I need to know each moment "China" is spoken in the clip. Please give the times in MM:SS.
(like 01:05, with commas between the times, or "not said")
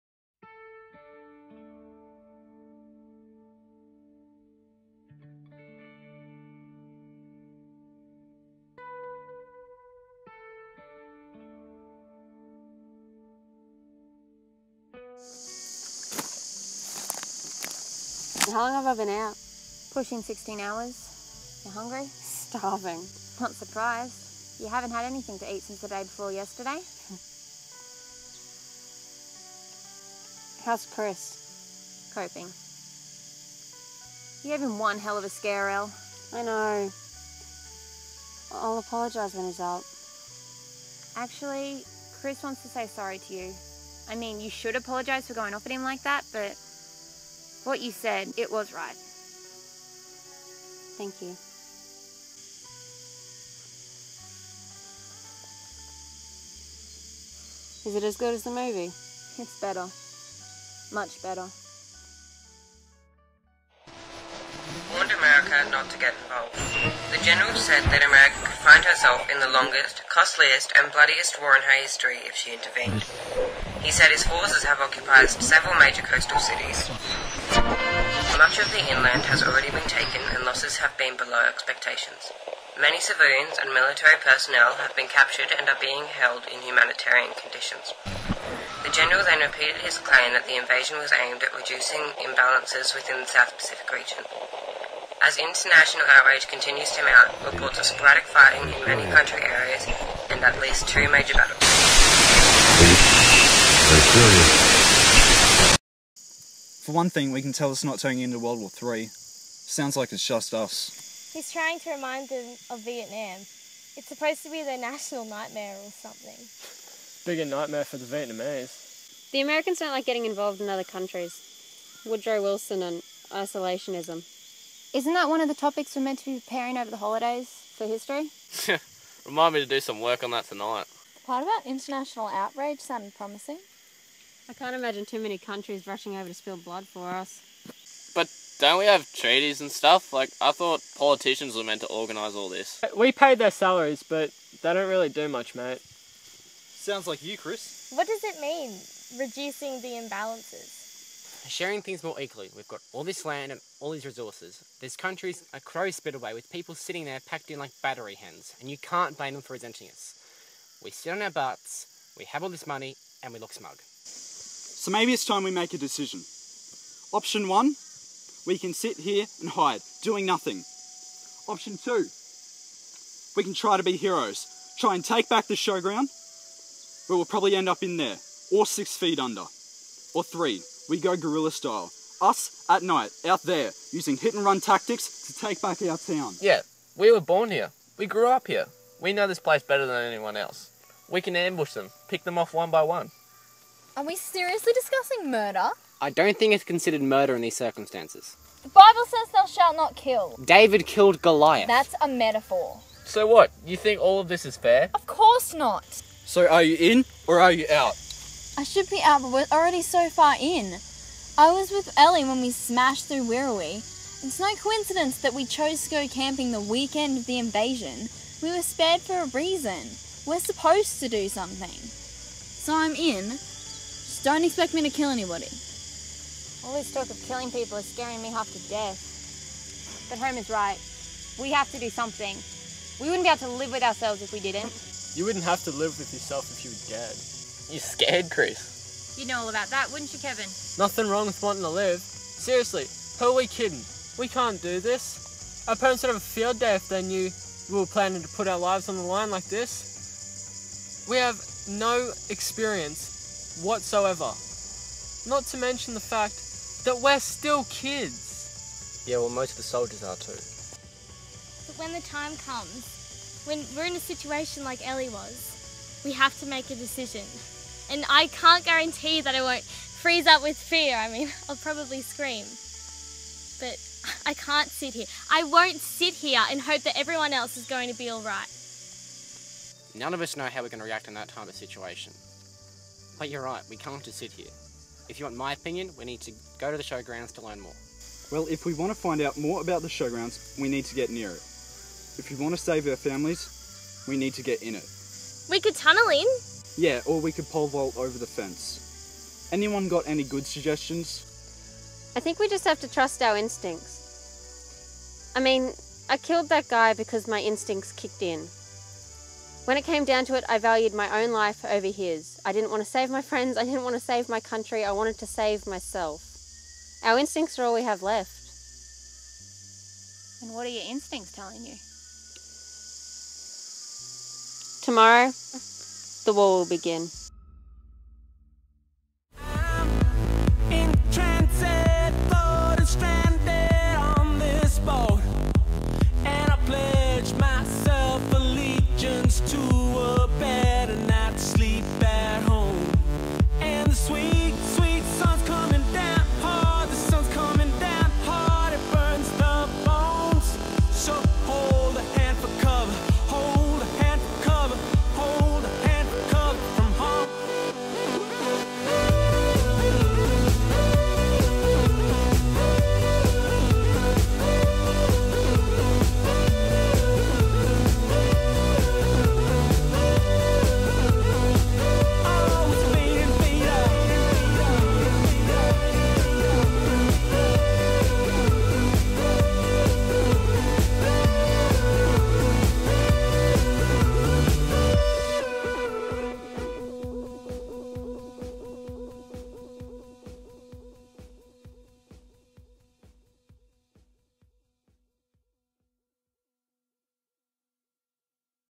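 not said.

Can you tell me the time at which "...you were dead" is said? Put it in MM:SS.
03:56.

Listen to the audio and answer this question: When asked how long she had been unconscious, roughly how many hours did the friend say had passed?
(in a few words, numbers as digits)
16 hours.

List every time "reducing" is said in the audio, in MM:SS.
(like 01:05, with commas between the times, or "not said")
01:31, 02:29.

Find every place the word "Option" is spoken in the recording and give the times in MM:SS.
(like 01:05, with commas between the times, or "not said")
02:47, 02:51.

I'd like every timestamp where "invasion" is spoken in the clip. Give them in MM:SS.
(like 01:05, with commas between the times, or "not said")
01:30, 03:37.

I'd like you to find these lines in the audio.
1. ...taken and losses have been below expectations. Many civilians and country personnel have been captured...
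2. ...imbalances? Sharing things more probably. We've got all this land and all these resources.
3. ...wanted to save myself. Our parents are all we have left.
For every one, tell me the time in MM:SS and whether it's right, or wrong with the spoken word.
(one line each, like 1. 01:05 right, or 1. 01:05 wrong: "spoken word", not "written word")
1. 01:19 wrong: "military", not "country"
2. 02:30 wrong: "equally", not "probably"
3. 05:14 wrong: "instincts", not "parents".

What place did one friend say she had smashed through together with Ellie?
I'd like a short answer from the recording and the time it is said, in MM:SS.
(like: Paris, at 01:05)
Wirrawee, at 03:33.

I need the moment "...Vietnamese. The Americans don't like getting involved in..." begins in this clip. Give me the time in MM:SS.
01:58.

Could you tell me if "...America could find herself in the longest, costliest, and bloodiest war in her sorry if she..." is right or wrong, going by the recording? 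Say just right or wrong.
wrong.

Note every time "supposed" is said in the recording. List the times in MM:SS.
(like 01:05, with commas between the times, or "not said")
01:54, 03:40.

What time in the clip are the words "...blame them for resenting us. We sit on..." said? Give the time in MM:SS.
02:39.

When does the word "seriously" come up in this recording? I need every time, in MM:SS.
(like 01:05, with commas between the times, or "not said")
03:14, 04:01.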